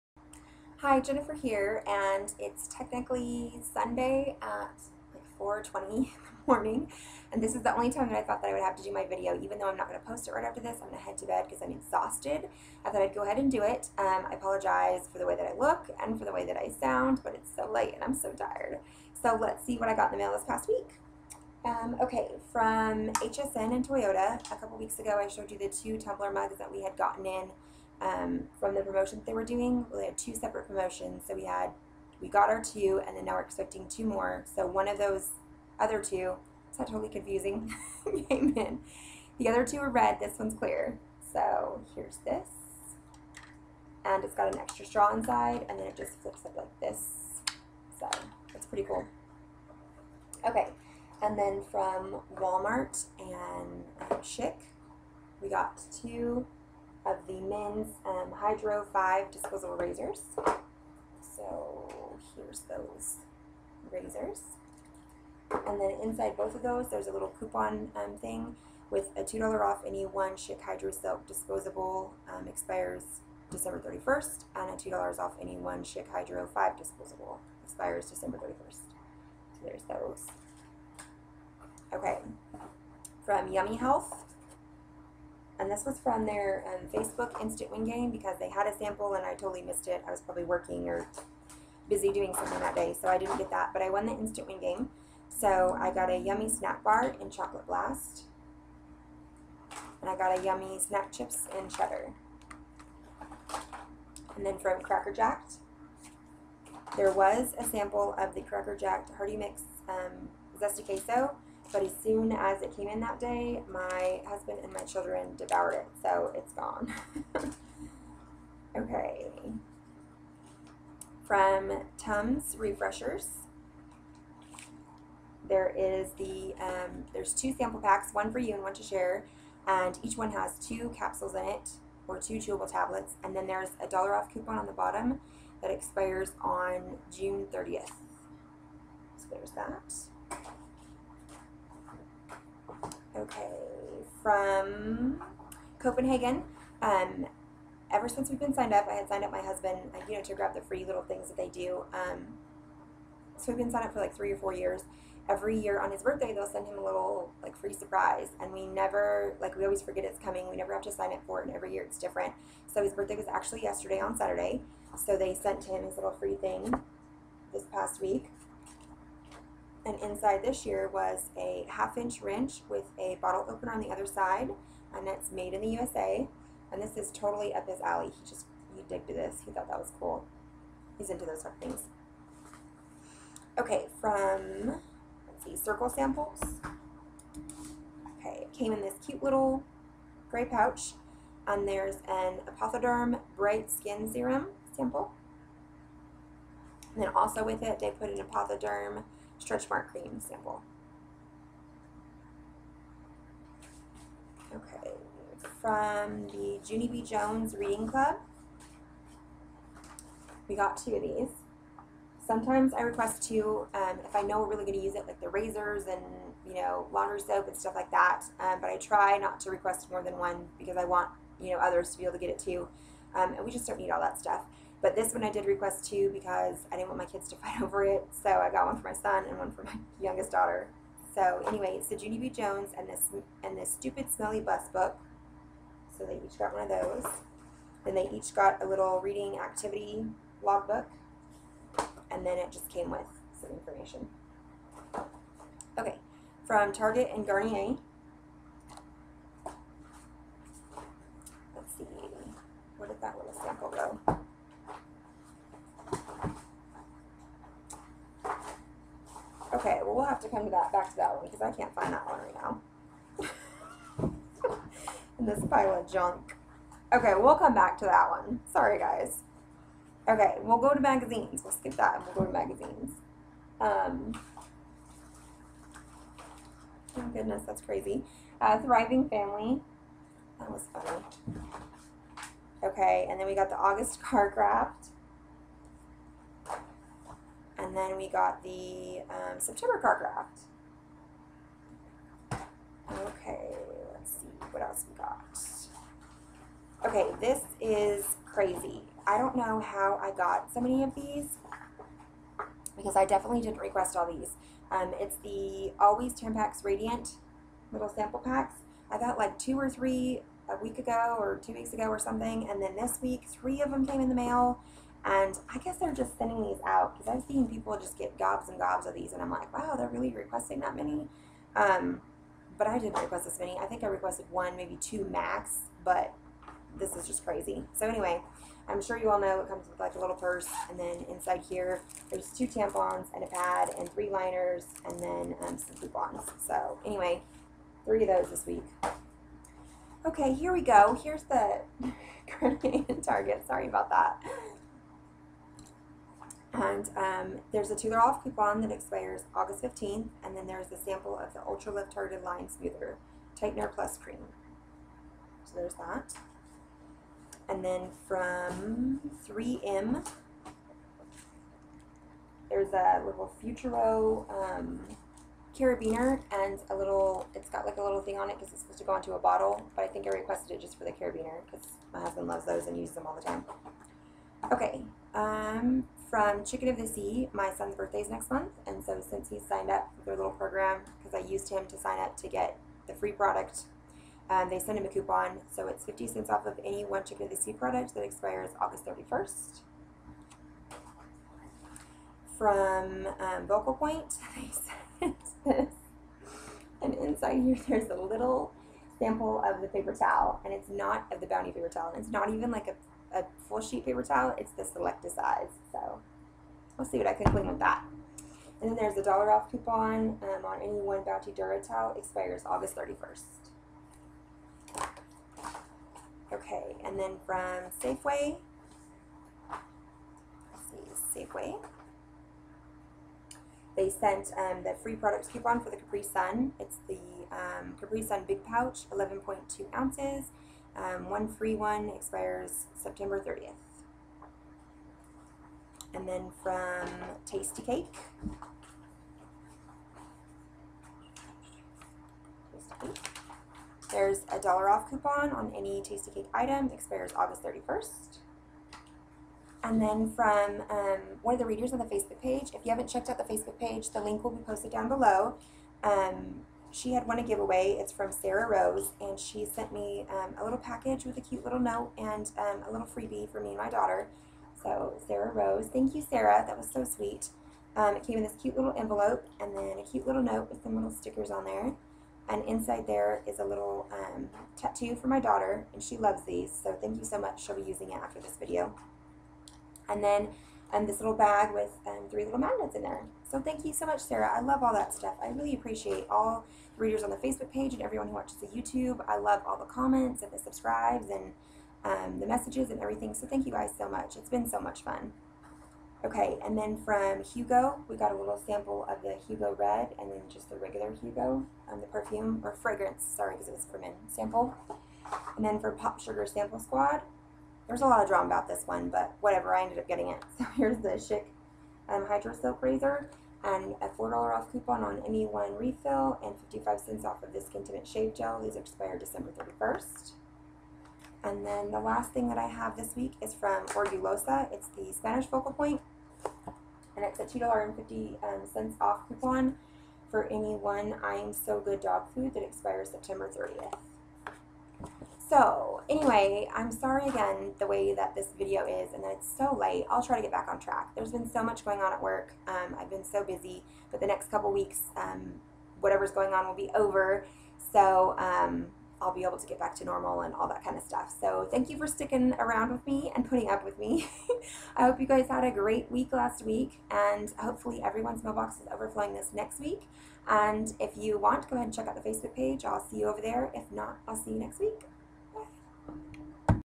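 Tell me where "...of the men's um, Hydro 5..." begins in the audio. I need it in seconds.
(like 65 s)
57 s.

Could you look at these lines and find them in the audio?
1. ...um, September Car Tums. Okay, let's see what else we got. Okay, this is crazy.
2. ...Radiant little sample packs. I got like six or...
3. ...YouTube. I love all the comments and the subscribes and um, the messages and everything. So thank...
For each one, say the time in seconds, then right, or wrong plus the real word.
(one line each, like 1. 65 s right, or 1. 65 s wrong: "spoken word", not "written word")
1. 289 s wrong: "Craft", not "Tums"
2. 306 s wrong: "two", not "six"
3. 488 s right.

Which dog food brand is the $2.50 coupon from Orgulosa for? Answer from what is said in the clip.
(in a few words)
I'm So Good.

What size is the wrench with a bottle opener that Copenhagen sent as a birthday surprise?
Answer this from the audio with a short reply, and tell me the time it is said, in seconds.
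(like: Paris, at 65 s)
Half inch, at 171 s.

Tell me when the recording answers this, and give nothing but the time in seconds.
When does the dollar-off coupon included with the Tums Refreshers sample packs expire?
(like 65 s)
137 s.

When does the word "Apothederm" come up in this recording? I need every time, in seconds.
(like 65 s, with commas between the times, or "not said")
192 s, 198 s.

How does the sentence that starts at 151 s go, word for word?
Um, so we've been signed up for like three or four years.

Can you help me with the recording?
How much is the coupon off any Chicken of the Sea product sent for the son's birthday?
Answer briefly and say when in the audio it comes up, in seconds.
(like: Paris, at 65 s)
50 cents, at 385 s.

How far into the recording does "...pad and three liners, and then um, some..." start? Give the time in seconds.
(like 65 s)
333 s.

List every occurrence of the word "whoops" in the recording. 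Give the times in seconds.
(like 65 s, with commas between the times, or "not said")
not said.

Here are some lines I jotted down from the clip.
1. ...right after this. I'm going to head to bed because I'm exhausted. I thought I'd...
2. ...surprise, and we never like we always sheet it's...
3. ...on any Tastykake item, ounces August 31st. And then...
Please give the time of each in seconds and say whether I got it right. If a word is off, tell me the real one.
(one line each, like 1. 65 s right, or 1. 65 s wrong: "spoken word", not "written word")
1. 10 s right
2. 157 s wrong: "forget", not "sheet"
3. 445 s wrong: "expires", not "ounces".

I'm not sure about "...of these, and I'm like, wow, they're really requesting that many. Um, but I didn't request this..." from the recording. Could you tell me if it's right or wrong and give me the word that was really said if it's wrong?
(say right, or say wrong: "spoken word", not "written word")
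right.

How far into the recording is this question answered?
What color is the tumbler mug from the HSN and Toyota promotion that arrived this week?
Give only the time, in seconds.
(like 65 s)
40 s.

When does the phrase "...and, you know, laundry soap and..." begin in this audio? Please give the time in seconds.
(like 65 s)
215 s.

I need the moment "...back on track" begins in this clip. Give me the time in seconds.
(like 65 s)
540 s.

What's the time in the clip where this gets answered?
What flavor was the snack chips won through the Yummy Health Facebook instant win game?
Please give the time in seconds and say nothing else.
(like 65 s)
101 s.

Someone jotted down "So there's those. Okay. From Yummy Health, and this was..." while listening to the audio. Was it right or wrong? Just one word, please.
right.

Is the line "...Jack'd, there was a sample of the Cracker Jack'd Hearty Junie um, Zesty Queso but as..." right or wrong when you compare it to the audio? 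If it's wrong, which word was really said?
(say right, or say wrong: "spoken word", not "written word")
wrong: "Mix", not "Junie".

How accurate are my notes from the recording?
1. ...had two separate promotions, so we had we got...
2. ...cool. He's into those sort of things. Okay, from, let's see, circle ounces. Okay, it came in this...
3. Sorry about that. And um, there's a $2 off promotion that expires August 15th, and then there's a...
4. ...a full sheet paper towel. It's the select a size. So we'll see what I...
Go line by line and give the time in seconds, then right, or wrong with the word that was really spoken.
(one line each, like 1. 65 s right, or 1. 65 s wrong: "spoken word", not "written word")
1. 30 s right
2. 179 s wrong: "samples", not "ounces"
3. 343 s wrong: "coupon", not "promotion"
4. 403 s right.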